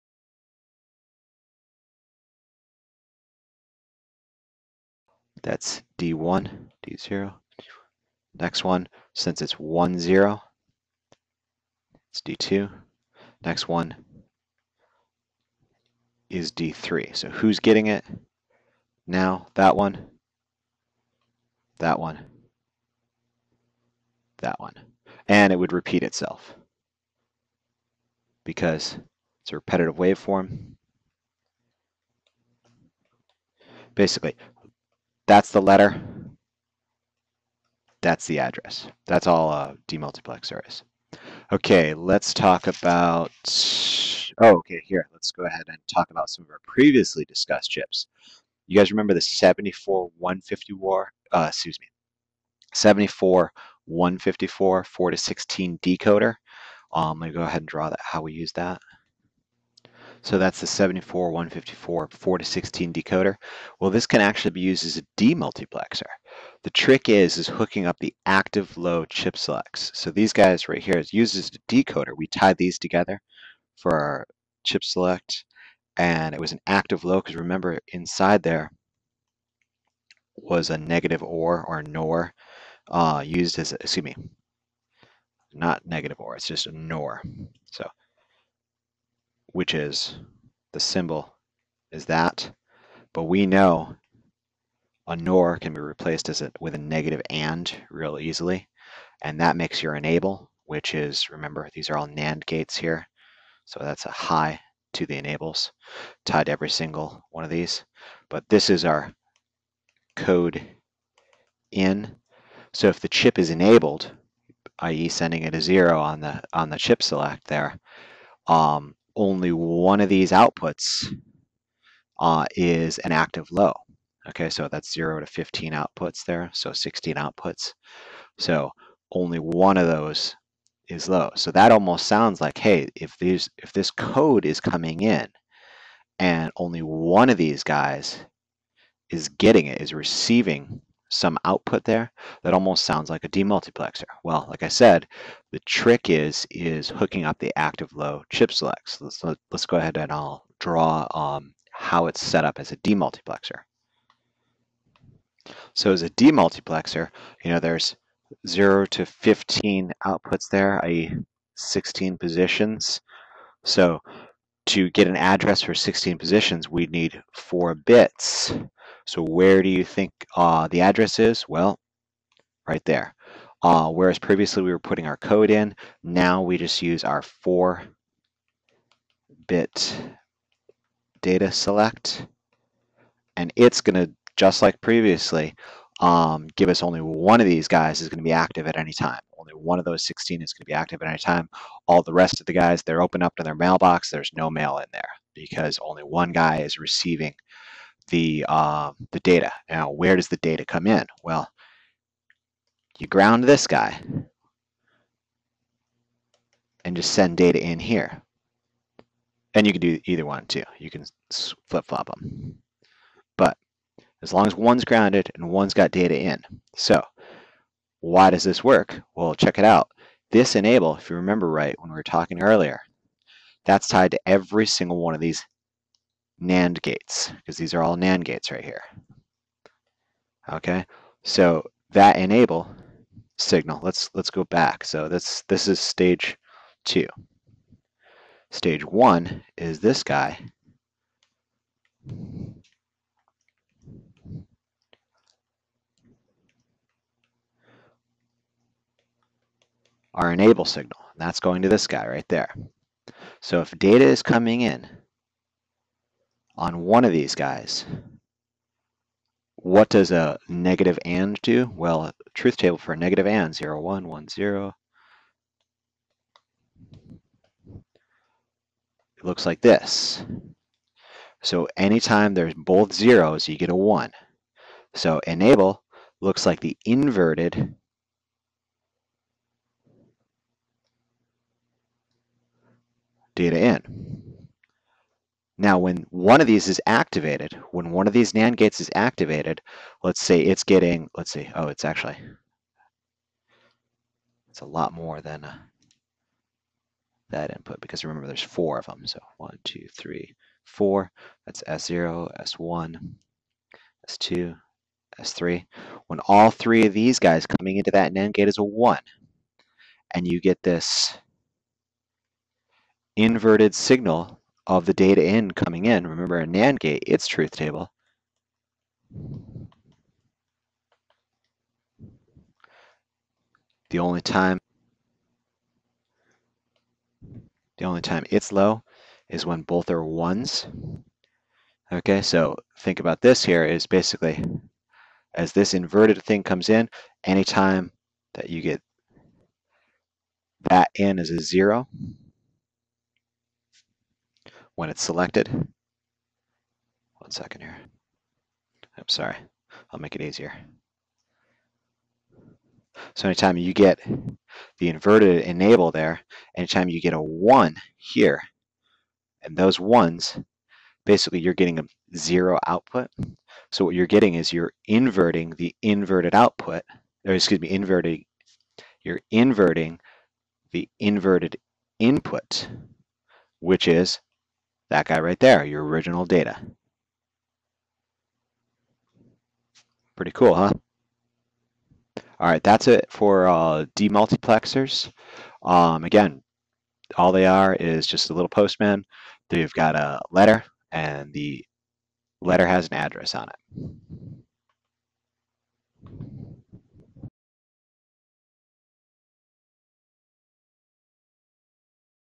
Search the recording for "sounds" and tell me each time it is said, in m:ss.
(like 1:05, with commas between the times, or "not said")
2:12, 2:22.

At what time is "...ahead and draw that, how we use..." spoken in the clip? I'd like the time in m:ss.
0:57.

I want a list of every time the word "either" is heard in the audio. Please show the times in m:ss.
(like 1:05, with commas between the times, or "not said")
3:30.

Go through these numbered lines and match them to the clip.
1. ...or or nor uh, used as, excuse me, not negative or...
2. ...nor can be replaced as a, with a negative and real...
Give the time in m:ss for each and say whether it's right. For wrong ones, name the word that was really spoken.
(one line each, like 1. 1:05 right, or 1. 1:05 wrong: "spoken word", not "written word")
1. 1:21 right
2. 1:35 right.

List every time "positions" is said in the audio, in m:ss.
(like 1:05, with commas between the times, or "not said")
2:42, 2:46.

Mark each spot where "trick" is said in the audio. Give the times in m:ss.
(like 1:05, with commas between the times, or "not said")
1:06, 2:25.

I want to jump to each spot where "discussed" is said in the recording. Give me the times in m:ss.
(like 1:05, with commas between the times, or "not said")
0:47.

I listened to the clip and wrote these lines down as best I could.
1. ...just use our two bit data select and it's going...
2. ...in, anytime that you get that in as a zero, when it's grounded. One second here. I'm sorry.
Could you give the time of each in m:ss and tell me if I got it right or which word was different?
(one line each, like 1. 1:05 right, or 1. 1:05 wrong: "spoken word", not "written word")
1. 2:56 wrong: "four", not "two"
2. 5:36 wrong: "selected", not "grounded".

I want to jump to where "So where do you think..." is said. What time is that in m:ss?
2:49.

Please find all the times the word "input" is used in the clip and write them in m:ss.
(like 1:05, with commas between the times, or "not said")
4:57, 6:11.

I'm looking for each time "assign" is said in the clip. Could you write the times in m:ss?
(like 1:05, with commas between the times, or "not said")
not said.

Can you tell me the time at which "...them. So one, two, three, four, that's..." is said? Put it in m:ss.
4:58.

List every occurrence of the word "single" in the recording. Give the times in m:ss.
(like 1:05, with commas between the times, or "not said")
1:46, 3:44.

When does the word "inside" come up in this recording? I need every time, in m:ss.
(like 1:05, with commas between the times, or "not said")
1:17.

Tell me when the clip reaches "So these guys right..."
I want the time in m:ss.
1:09.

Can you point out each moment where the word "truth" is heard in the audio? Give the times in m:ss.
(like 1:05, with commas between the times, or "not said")
4:22, 5:17.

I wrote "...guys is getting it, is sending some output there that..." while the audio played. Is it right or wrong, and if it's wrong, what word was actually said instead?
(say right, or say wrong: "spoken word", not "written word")
wrong: "receiving", not "sending".